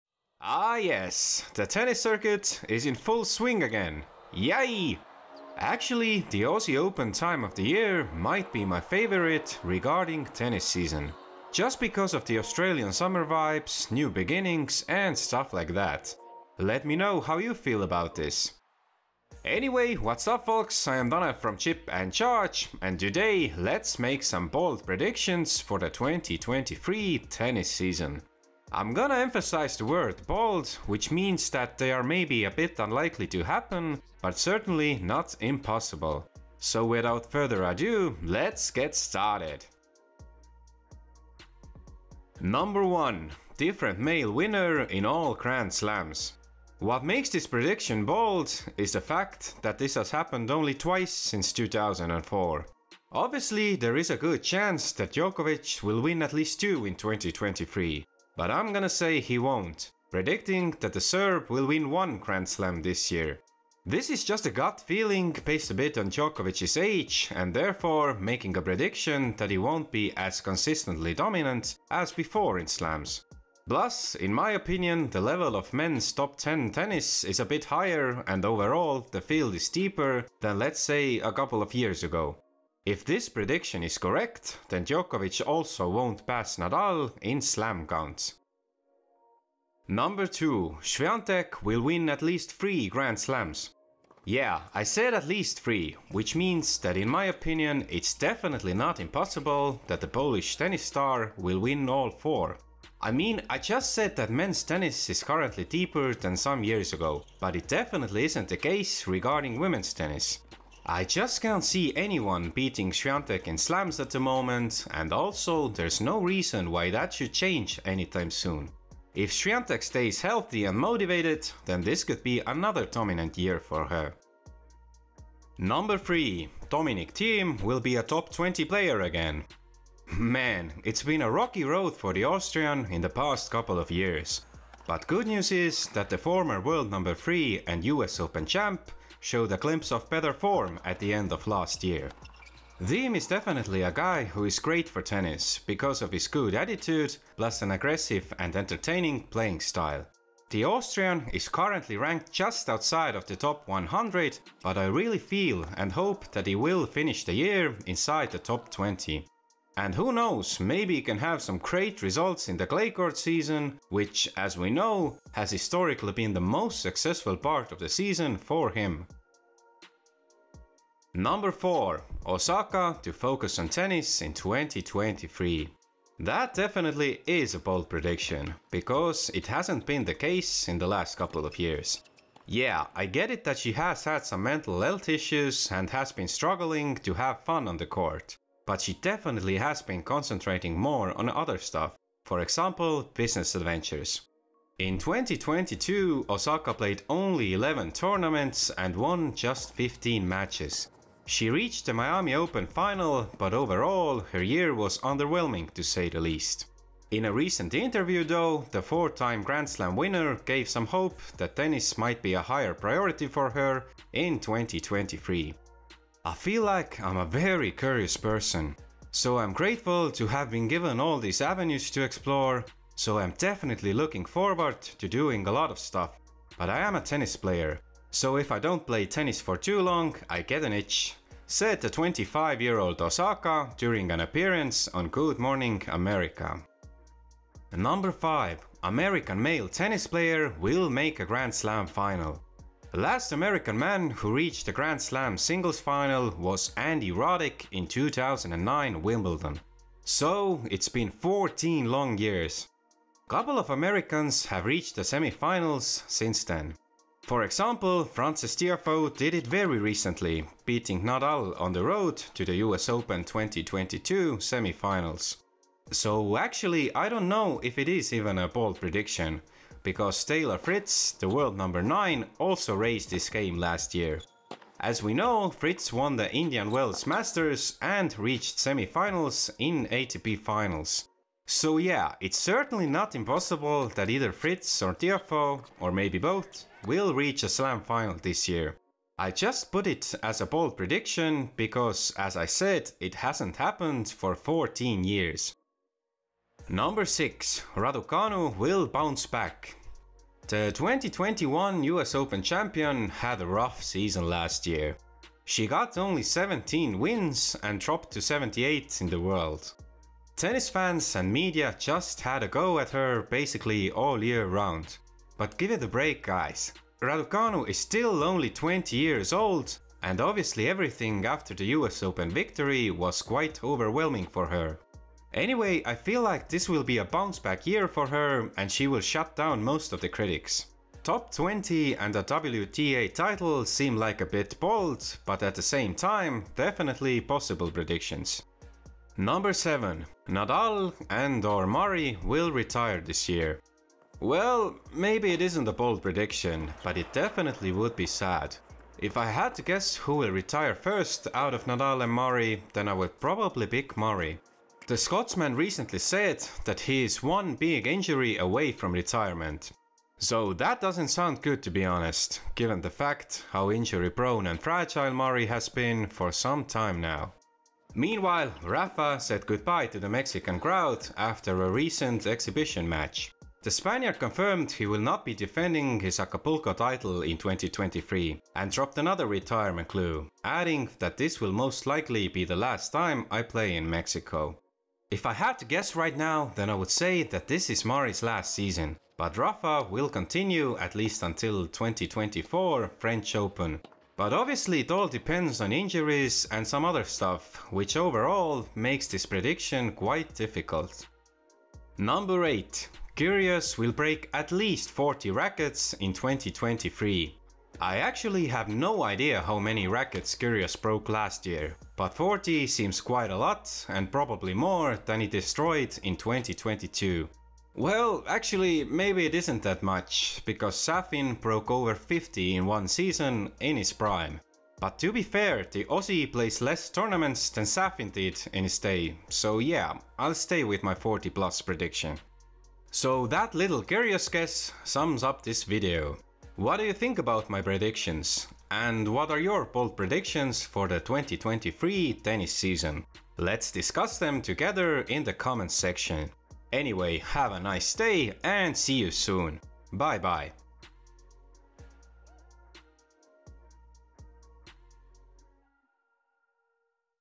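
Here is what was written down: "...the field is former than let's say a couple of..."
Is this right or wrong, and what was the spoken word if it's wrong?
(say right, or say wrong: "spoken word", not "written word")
wrong: "deeper", not "former".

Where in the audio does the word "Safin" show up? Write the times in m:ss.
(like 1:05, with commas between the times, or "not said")
7:00, 7:07.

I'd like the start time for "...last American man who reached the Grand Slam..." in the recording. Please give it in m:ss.
4:02.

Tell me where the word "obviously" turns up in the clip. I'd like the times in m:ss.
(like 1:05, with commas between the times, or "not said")
0:53, 5:20, 6:34.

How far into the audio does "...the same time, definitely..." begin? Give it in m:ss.
5:35.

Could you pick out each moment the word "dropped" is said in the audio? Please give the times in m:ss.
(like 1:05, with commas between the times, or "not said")
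5:07, 6:18.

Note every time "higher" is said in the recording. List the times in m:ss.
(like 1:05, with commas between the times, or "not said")
1:17, 3:32.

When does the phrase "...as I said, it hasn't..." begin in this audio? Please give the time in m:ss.
4:52.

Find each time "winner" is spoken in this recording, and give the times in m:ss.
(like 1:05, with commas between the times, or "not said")
0:44, 3:29.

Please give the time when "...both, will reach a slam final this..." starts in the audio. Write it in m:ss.
4:46.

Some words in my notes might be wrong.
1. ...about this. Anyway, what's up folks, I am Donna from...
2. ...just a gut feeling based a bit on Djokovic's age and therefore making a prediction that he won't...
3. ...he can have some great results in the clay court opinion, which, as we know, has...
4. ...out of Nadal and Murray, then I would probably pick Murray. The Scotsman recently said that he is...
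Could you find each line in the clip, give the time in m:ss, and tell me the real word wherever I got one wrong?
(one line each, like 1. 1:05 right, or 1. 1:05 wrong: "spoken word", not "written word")
1. 0:17 right
2. 1:04 right
3. 2:40 wrong: "season", not "opinion"
4. 5:51 right.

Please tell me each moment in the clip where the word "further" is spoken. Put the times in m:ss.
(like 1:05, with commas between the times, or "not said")
0:37.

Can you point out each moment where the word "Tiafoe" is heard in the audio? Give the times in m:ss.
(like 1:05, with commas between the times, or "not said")
4:18, 4:44.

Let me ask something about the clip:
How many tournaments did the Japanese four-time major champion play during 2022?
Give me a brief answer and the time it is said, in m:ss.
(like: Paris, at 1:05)
11, at 3:17.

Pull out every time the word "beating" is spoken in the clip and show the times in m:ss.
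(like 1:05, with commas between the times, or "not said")
1:52, 4:20.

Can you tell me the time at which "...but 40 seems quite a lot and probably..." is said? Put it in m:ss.
6:51.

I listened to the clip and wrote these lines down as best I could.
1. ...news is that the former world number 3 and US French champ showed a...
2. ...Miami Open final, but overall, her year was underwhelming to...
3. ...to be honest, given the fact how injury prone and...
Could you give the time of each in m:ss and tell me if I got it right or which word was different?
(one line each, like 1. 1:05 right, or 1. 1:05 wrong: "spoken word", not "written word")
1. 2:15 wrong: "Open", not "French"
2. 3:21 right
3. 6:01 right.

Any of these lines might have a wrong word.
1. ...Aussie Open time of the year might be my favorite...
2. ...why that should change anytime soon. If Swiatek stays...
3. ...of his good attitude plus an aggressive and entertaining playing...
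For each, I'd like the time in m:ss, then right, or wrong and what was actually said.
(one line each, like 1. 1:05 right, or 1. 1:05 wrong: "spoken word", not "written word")
1. 0:06 right
2. 1:56 right
3. 2:26 right.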